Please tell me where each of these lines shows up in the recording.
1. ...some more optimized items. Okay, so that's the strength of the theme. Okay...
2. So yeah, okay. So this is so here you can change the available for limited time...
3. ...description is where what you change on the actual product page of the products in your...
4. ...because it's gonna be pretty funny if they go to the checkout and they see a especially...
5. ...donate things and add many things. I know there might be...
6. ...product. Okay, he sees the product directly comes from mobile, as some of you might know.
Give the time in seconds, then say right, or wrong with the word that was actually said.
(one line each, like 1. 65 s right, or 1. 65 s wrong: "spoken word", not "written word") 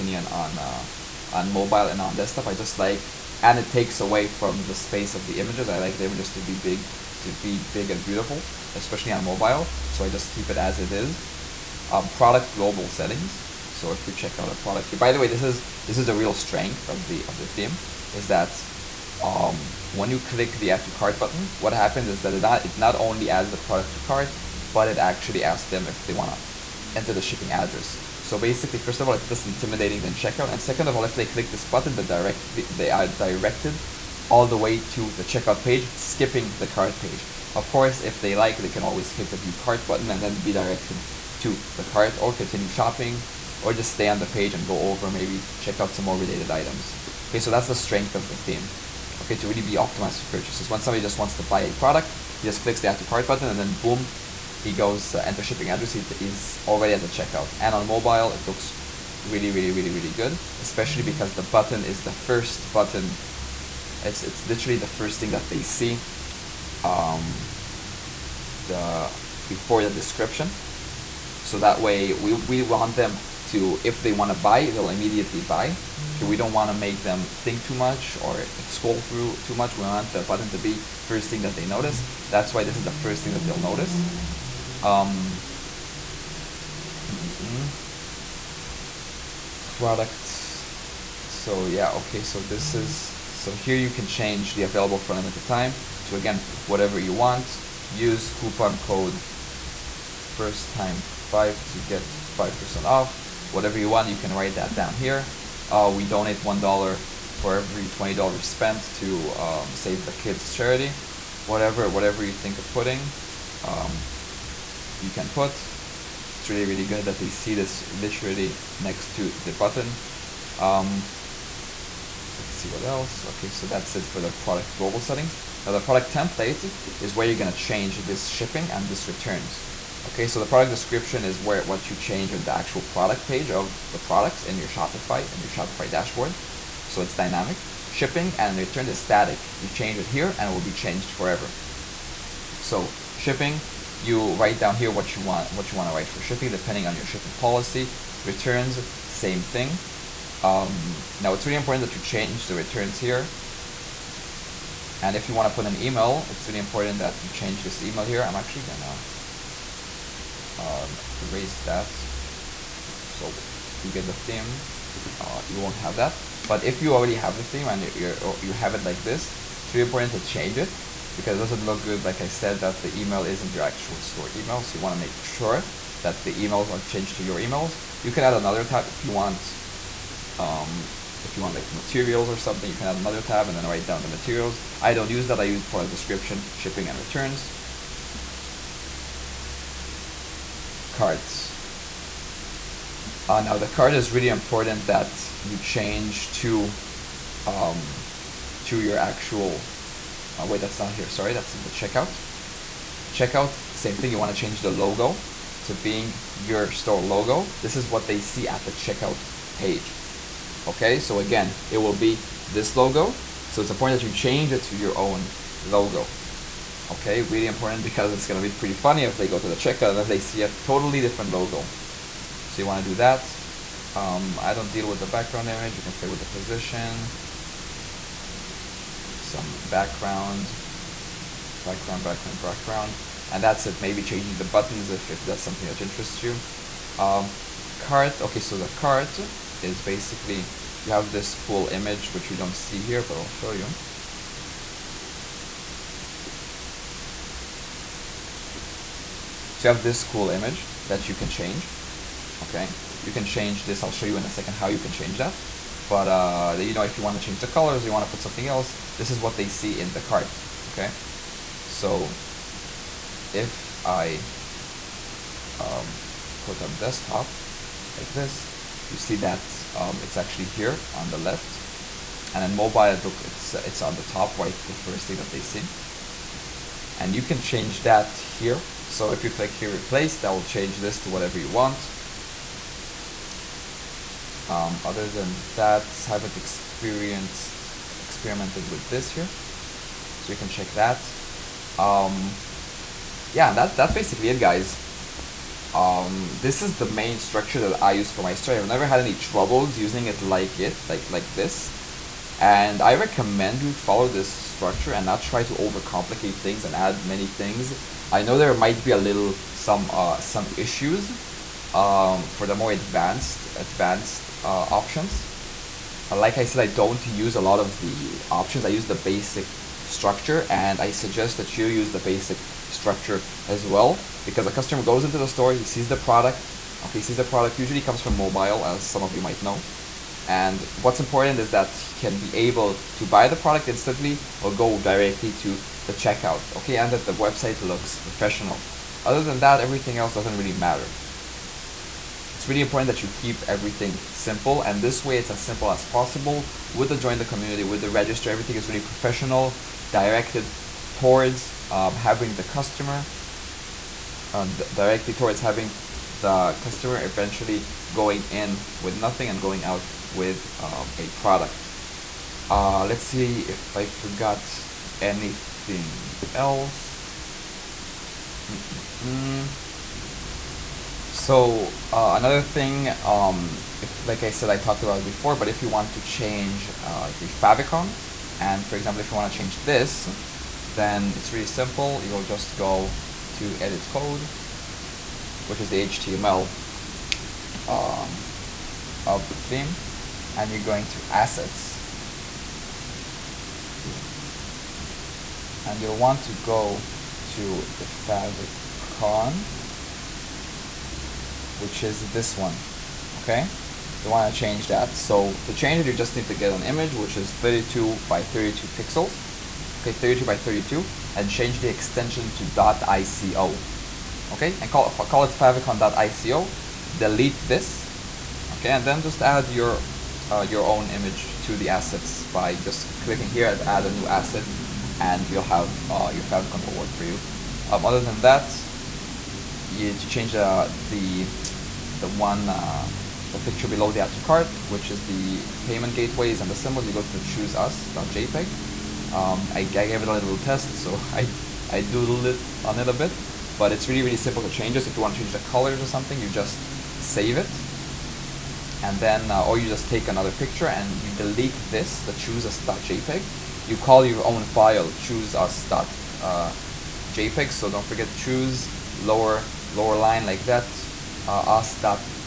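1. 45 s wrong: "related", not "optimized"
2. 91 s right
3. 130 s right
4. 217 s wrong: "totally", not "especially"
5. 305 s wrong: "overcomplicate", not "donate"
6. 325 s wrong: "usually", not "directly".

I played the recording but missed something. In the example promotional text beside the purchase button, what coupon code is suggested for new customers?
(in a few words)
first time five.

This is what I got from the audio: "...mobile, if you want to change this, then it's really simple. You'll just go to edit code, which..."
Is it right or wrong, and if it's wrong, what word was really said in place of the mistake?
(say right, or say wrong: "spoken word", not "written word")
wrong: "example", not "mobile".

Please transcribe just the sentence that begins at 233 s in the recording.
Maybe changing the buttons if, if that's something that interests you.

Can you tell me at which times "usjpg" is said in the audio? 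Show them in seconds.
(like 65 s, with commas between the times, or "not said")
437 s, 461 s.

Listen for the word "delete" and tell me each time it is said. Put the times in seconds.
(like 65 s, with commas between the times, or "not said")
416 s, 451 s.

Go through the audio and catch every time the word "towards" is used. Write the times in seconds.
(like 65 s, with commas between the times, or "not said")
350 s, 355 s.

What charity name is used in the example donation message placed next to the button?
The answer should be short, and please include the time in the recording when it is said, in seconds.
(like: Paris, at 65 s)
Save the kids, at 109 s.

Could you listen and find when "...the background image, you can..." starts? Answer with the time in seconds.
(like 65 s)
224 s.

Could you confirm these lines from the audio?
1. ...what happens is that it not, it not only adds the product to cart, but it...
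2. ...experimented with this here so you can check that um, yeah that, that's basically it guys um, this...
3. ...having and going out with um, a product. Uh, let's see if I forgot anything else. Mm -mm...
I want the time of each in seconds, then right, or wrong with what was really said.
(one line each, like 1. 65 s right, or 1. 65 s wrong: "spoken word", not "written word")
1. 21 s right
2. 287 s right
3. 358 s wrong: "nothing", not "having".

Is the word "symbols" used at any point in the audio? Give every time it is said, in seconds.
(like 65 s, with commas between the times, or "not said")
436 s.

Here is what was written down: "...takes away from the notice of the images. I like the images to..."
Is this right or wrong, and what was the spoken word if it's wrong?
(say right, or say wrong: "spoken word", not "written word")
wrong: "space", not "notice".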